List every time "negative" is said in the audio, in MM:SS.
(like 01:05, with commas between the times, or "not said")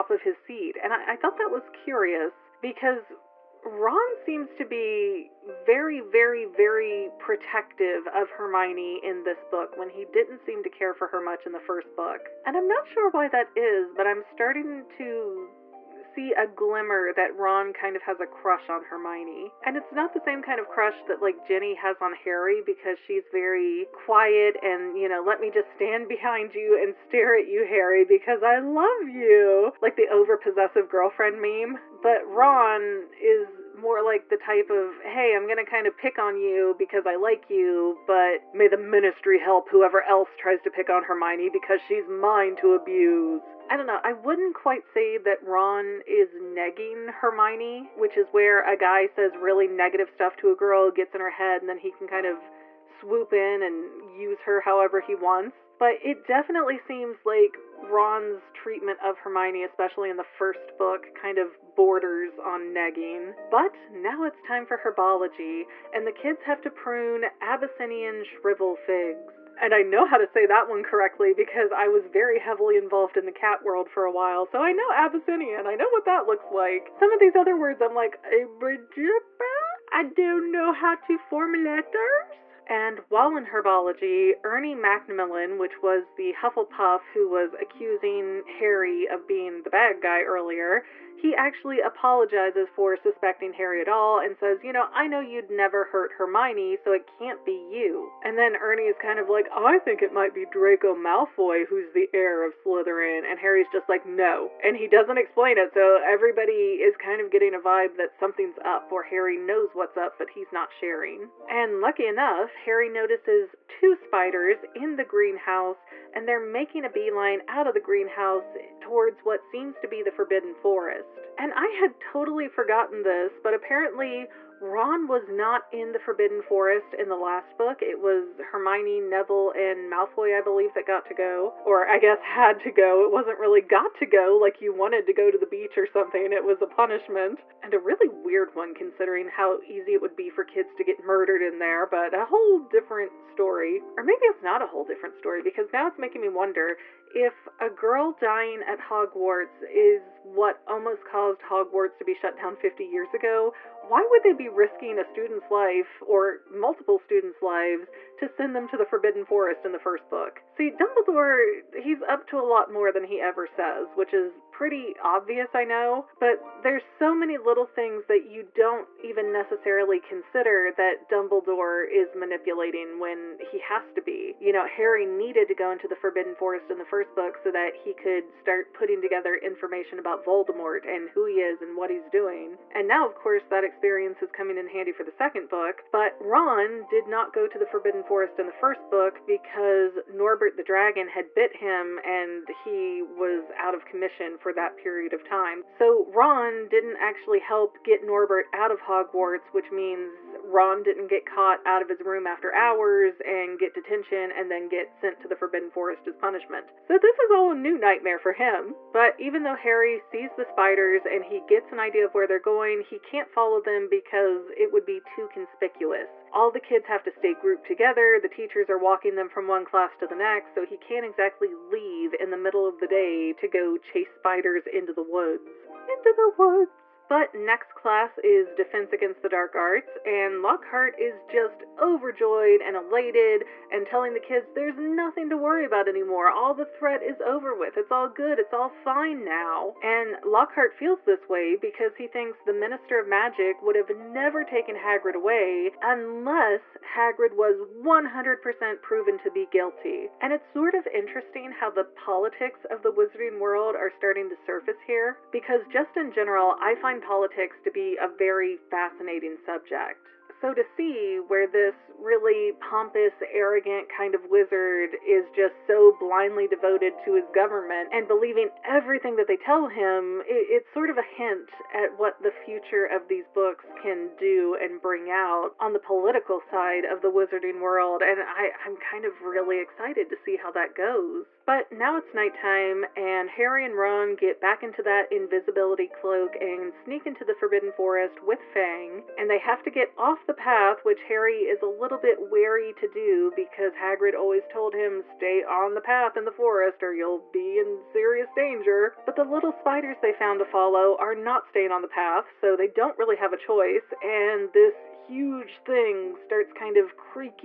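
00:49.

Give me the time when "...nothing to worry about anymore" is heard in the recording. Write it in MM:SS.
03:54.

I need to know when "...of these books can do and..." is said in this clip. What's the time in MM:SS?
04:32.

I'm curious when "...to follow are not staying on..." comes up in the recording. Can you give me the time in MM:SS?
05:00.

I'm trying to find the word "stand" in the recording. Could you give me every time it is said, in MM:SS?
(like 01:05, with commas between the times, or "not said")
00:25.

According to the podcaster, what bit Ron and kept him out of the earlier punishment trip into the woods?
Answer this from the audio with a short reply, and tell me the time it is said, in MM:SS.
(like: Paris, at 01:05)
Norbert the Dragon, at 03:10.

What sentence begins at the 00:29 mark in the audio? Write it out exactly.
Like the over possessive girlfriend meme.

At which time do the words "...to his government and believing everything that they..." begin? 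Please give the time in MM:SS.
04:26.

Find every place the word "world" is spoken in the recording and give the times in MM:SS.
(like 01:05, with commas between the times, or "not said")
01:13, 04:13, 04:37.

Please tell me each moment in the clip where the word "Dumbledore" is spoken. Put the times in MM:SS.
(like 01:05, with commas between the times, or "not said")
02:40, 02:51.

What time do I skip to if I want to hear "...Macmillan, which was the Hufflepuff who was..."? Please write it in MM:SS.
01:24.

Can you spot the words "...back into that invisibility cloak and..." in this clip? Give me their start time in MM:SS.
04:44.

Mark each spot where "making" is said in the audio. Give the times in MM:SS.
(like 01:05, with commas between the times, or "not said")
01:56, 02:25.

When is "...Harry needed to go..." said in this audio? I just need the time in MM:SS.
02:54.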